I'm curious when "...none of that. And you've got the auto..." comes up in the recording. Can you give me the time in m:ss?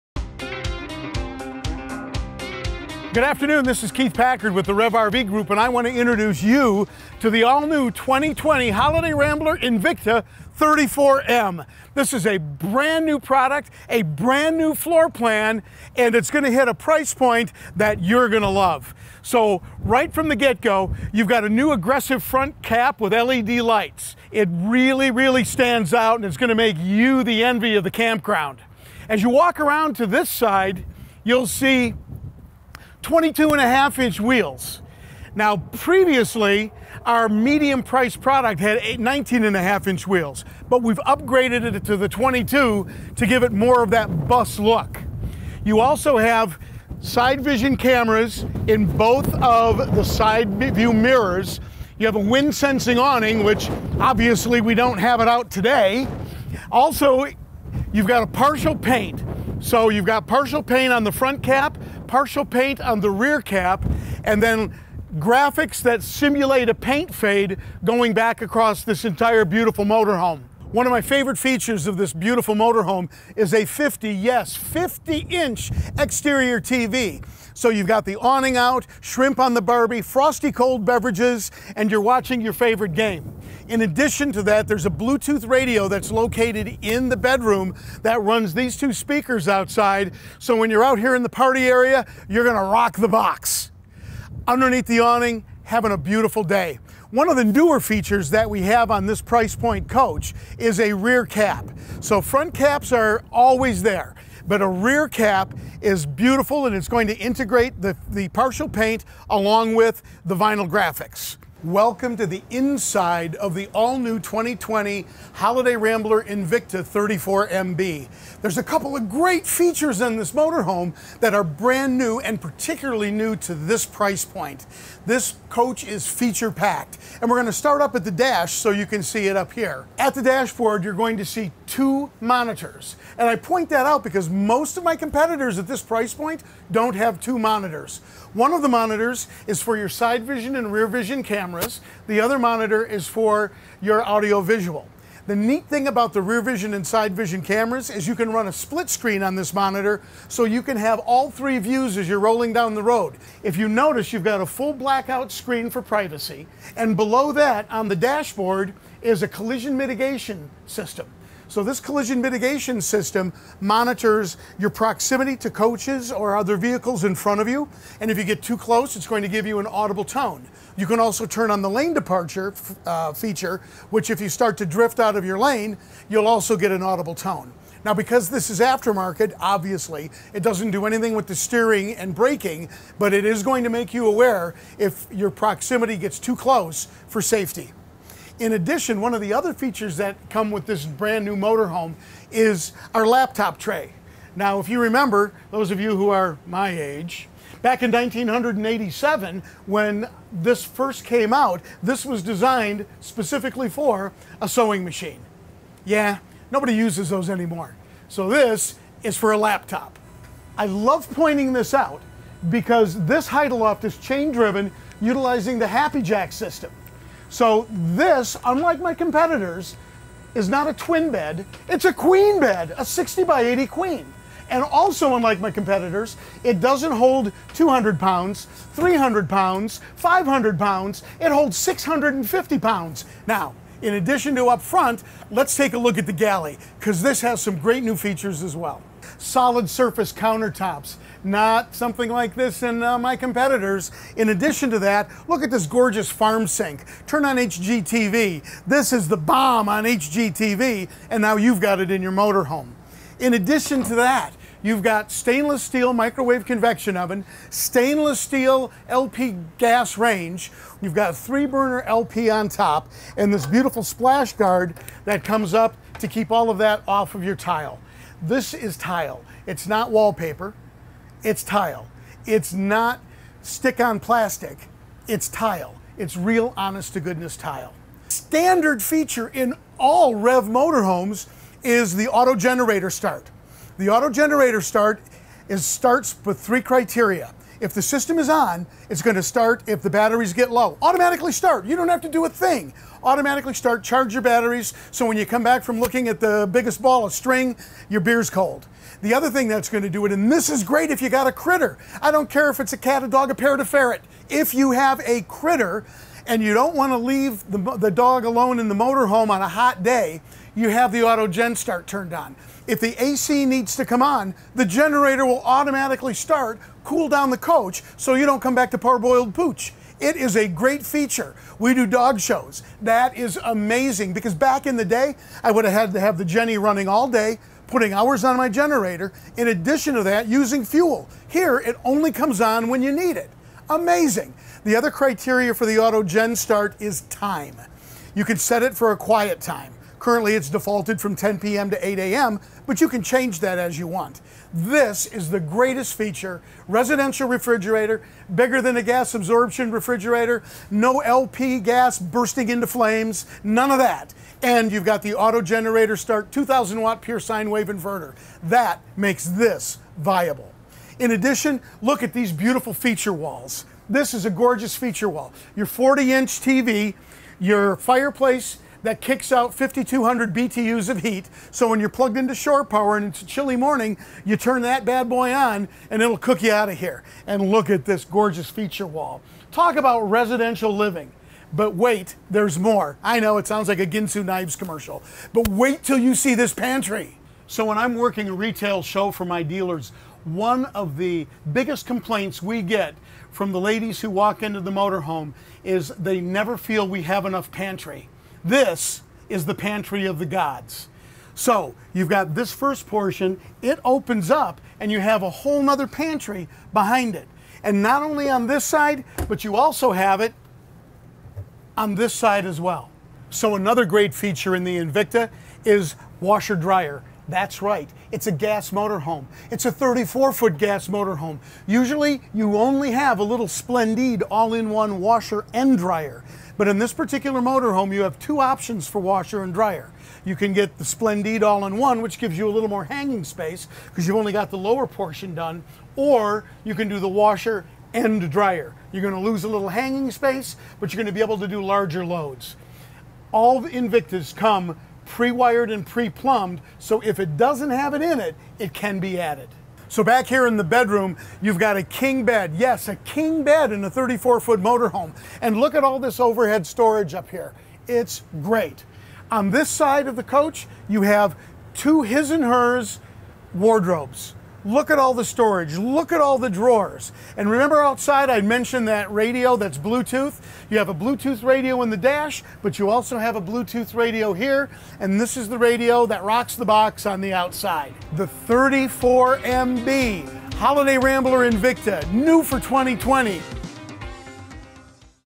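5:53.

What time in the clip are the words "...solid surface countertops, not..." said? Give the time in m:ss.
3:59.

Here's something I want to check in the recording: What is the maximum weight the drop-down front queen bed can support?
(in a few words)
650 pounds.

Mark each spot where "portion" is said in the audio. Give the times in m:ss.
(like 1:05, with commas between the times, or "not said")
6:42, 7:14.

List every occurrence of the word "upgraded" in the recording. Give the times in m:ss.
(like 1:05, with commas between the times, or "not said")
0:40.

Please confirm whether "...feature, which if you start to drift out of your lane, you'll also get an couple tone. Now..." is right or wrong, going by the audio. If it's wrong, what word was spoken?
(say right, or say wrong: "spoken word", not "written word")
wrong: "audible", not "couple".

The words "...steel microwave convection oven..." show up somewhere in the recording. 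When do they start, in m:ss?
4:15.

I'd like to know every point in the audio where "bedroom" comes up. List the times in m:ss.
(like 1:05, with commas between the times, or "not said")
1:27, 7:30.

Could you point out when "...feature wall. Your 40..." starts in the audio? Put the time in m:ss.
6:04.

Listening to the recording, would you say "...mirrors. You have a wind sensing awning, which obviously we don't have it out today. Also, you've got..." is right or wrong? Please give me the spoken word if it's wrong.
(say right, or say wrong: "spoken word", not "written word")
right.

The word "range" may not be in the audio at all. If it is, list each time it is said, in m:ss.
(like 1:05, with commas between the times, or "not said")
4:19.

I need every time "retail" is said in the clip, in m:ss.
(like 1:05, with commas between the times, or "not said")
6:28.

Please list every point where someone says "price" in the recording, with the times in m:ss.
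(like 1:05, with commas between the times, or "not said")
0:16, 0:37, 1:39, 2:03, 2:15.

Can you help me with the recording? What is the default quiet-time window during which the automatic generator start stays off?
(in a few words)
10 p.m. to 8 a.m.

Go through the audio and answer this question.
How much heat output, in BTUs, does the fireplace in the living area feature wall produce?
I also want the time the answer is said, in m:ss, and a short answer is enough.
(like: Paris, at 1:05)
5,200 BTUs, at 6:09.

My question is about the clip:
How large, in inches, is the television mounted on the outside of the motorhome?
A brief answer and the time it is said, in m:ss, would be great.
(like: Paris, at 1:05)
50 inch, at 1:14.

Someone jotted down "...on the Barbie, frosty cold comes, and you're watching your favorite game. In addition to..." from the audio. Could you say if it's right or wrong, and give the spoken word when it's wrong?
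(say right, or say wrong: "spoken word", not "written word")
wrong: "beverages", not "comes".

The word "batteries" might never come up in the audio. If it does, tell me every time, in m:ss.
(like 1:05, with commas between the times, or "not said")
4:49, 4:54.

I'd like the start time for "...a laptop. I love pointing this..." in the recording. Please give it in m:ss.
3:29.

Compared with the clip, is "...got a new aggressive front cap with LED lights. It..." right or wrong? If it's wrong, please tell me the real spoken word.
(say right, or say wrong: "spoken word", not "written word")
right.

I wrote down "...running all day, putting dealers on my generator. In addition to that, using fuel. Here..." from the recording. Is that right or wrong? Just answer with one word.
wrong.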